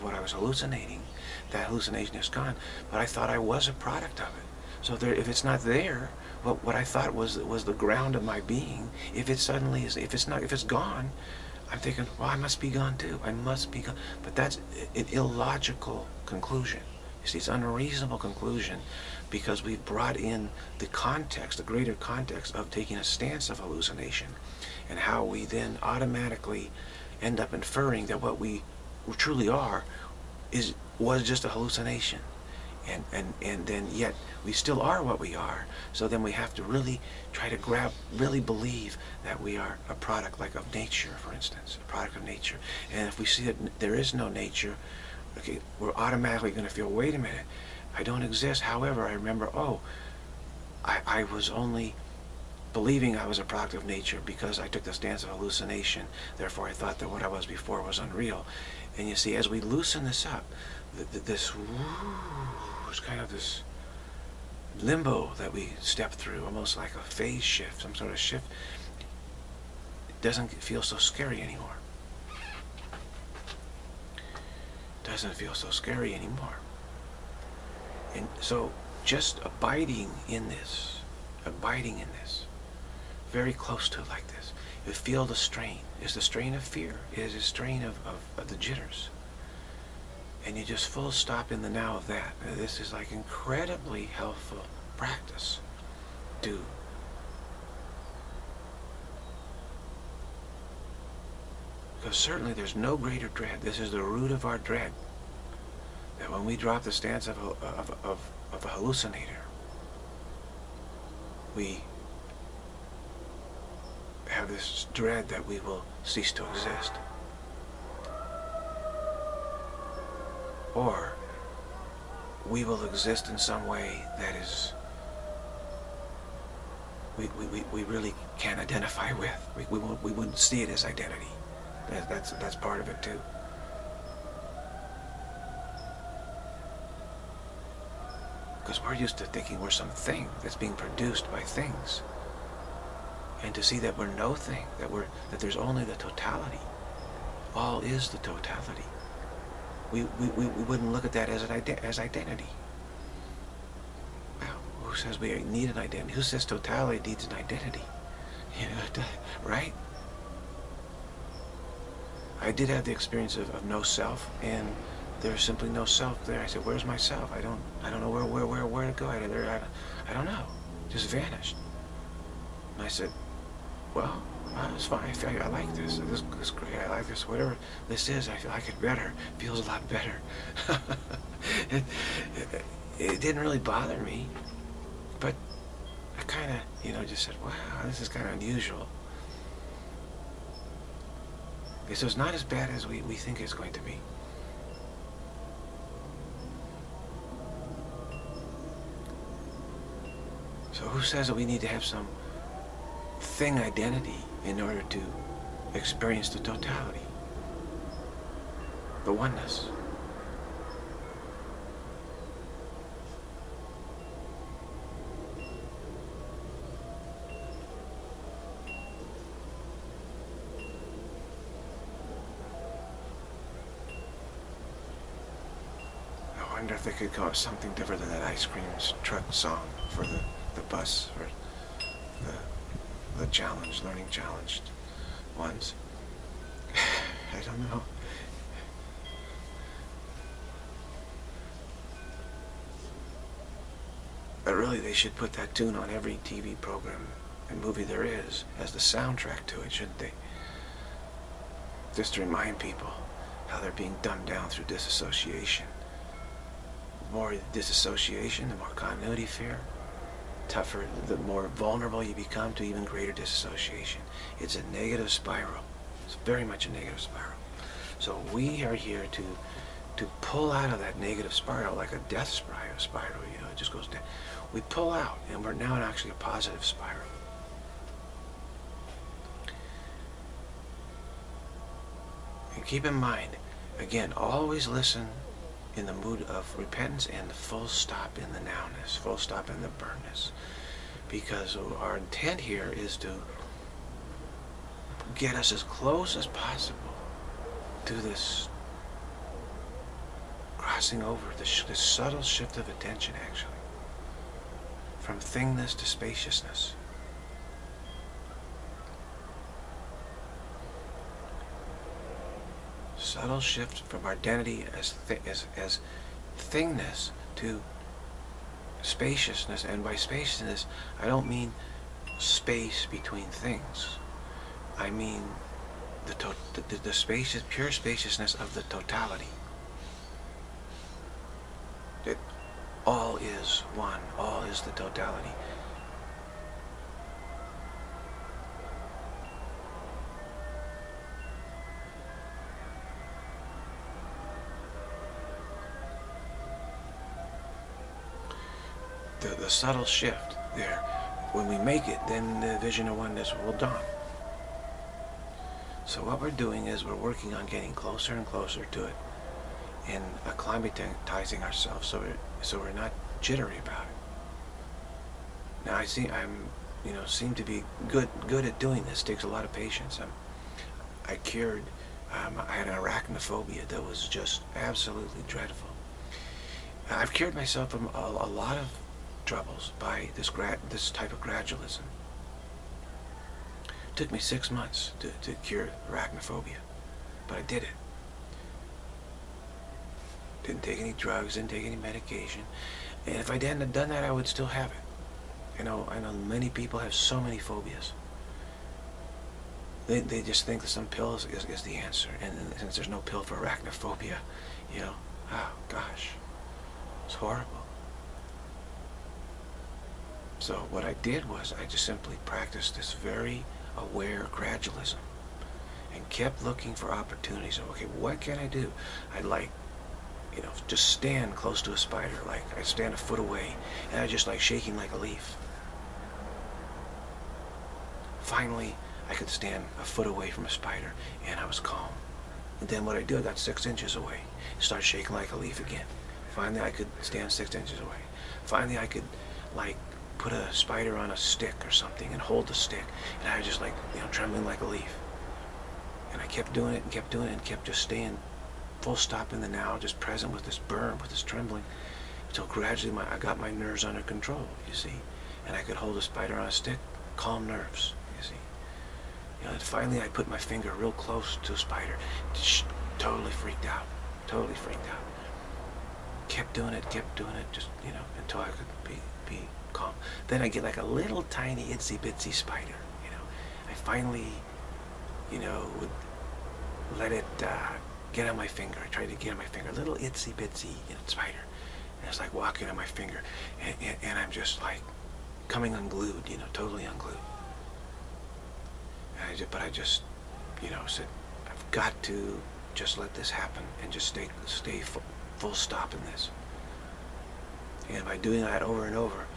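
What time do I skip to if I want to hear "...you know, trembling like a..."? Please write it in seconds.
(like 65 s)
443 s.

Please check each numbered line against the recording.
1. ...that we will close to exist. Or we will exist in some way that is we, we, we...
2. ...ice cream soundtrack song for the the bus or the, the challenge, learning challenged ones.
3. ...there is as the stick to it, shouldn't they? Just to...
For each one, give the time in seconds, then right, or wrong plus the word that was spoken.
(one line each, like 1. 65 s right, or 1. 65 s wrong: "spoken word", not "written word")
1. 115 s wrong: "cease", not "close"
2. 228 s wrong: "truck", not "soundtrack"
3. 247 s wrong: "soundtrack", not "stick".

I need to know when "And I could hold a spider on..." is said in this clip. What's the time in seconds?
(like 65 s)
455 s.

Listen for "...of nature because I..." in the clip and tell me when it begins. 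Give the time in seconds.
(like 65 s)
53 s.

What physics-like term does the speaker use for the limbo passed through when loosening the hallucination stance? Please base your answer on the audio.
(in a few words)
phase shift.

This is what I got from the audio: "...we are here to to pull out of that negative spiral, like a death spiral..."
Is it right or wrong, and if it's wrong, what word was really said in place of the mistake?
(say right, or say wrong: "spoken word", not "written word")
right.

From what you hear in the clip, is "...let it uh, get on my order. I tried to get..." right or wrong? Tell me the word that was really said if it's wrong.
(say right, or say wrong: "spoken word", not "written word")
wrong: "finger", not "order".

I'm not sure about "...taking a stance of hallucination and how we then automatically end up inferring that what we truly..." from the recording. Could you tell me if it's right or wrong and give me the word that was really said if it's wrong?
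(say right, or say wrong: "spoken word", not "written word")
right.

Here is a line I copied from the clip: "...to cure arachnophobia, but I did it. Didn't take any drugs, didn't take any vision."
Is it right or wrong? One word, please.
wrong.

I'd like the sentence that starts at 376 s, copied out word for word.
I've cured myself from a, a lot of troubles by this this type of gradualism.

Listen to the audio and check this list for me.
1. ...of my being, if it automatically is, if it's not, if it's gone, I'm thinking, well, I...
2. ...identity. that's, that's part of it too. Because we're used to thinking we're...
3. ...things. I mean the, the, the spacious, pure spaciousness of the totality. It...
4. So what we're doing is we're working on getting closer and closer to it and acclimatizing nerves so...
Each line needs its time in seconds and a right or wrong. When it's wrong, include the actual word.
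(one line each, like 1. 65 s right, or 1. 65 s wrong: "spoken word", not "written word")
1. 8 s wrong: "suddenly", not "automatically"
2. 130 s right
3. 323 s right
4. 355 s wrong: "ourselves", not "nerves".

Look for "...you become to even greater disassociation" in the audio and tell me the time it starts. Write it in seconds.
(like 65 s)
262 s.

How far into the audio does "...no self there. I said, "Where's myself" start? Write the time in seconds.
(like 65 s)
165 s.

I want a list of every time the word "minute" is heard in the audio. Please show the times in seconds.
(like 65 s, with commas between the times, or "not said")
47 s.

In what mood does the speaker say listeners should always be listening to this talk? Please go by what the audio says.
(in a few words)
repentance.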